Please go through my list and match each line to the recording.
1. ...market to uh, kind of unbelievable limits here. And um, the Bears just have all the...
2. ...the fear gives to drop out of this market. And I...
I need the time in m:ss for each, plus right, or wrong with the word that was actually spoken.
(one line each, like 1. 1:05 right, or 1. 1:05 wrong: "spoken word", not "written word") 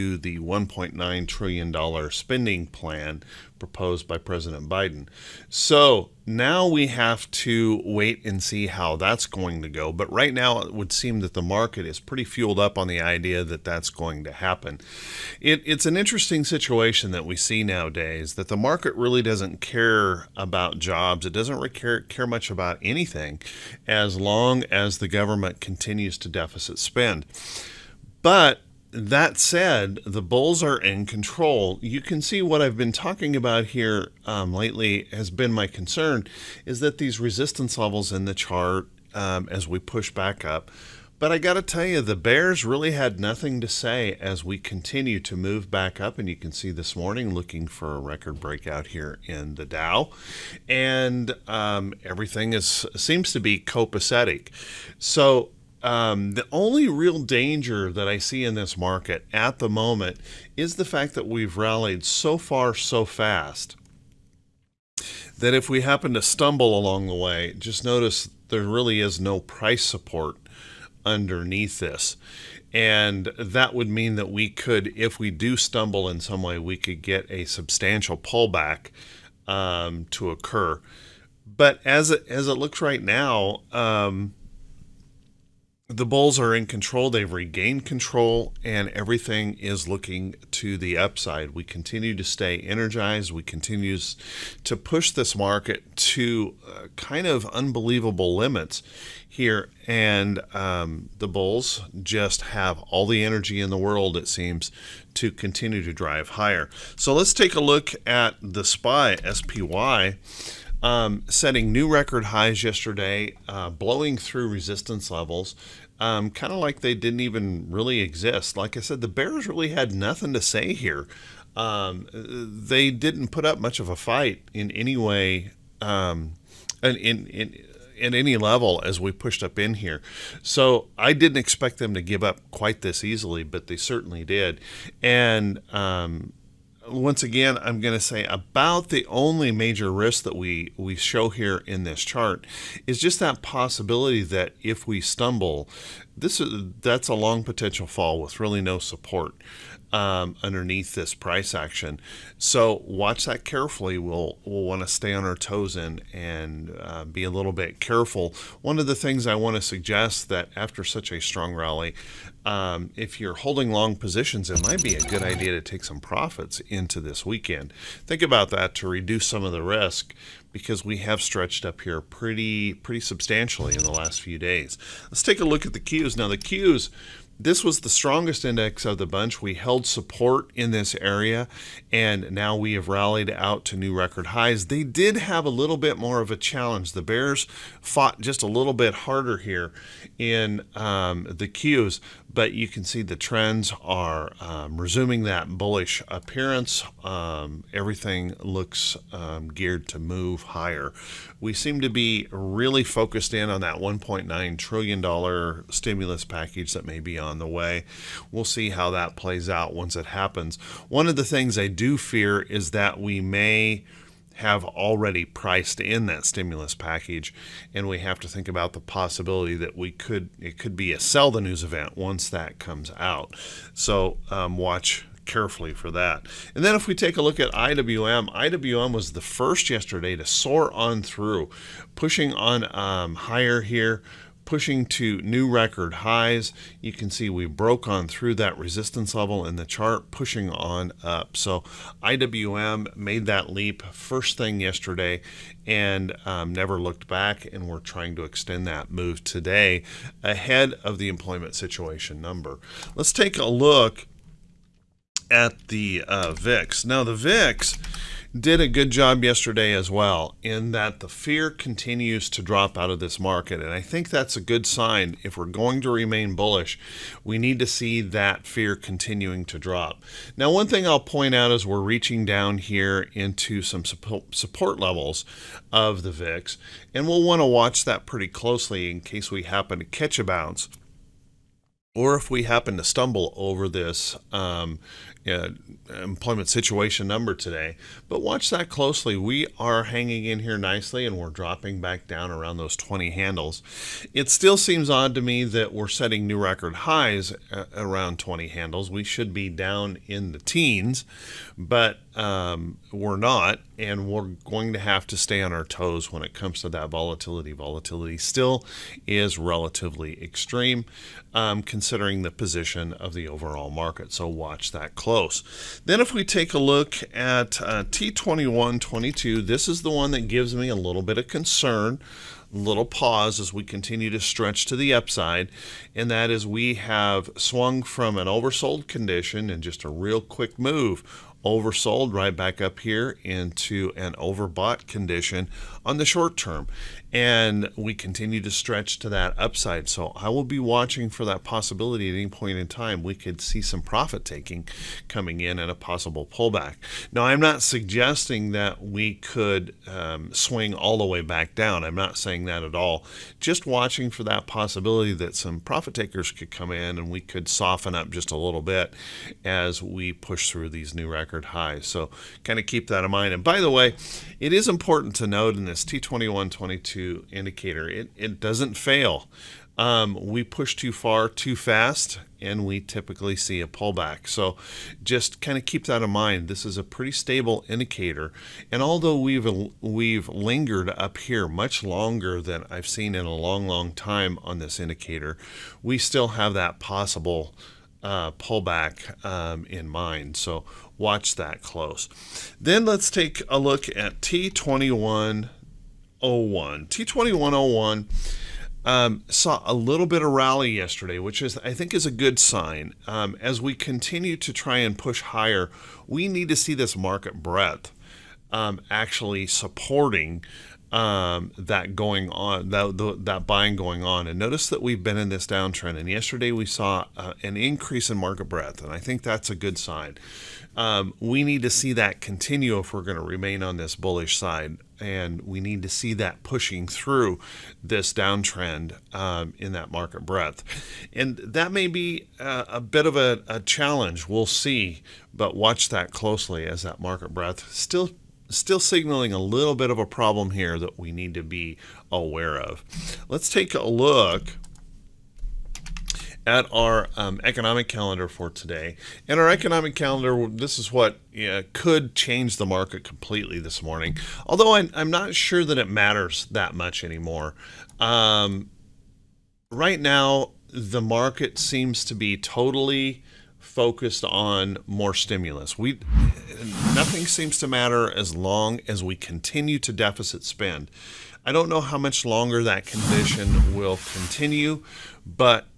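1. 1:35 wrong: "Bulls", not "Bears"
2. 4:20 wrong: "continues", not "gives".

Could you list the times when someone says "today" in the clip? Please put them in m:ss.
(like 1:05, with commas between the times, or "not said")
4:09, 4:47, 7:28.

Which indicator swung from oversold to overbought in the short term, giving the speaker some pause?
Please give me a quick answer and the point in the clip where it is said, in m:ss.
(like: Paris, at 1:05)
T2122, at 5:17.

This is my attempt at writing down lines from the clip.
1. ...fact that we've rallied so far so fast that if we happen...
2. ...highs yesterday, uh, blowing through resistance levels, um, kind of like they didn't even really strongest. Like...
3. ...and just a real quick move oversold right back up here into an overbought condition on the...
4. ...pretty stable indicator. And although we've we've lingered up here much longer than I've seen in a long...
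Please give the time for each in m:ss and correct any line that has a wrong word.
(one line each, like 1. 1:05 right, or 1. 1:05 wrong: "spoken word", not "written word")
1. 1:00 right
2. 1:52 wrong: "exist", not "strongest"
3. 5:29 right
4. 6:16 right.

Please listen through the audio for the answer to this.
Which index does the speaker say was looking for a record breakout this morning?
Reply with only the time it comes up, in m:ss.
0:49.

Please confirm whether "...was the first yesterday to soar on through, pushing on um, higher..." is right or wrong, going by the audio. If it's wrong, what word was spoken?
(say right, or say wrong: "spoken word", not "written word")
right.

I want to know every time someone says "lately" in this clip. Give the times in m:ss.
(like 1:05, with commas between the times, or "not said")
0:34.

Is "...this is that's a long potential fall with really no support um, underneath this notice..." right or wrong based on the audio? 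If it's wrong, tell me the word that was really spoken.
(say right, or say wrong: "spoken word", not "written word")
wrong: "price", not "notice".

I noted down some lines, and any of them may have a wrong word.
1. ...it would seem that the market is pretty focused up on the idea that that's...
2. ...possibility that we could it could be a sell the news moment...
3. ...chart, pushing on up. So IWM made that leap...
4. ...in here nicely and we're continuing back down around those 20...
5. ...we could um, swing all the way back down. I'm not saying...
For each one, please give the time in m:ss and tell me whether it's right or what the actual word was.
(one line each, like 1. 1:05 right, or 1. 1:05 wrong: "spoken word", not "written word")
1. 0:10 wrong: "fueled", not "focused"
2. 3:38 wrong: "event", not "moment"
3. 3:59 right
4. 4:50 wrong: "dropping", not "continuing"
5. 5:48 right.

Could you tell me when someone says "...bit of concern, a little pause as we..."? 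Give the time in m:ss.
5:21.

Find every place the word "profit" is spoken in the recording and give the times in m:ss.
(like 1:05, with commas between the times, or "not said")
2:45, 5:43, 5:55.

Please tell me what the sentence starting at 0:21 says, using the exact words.
It doesn't really care, care much about anything as long as the government continues to deficit spend.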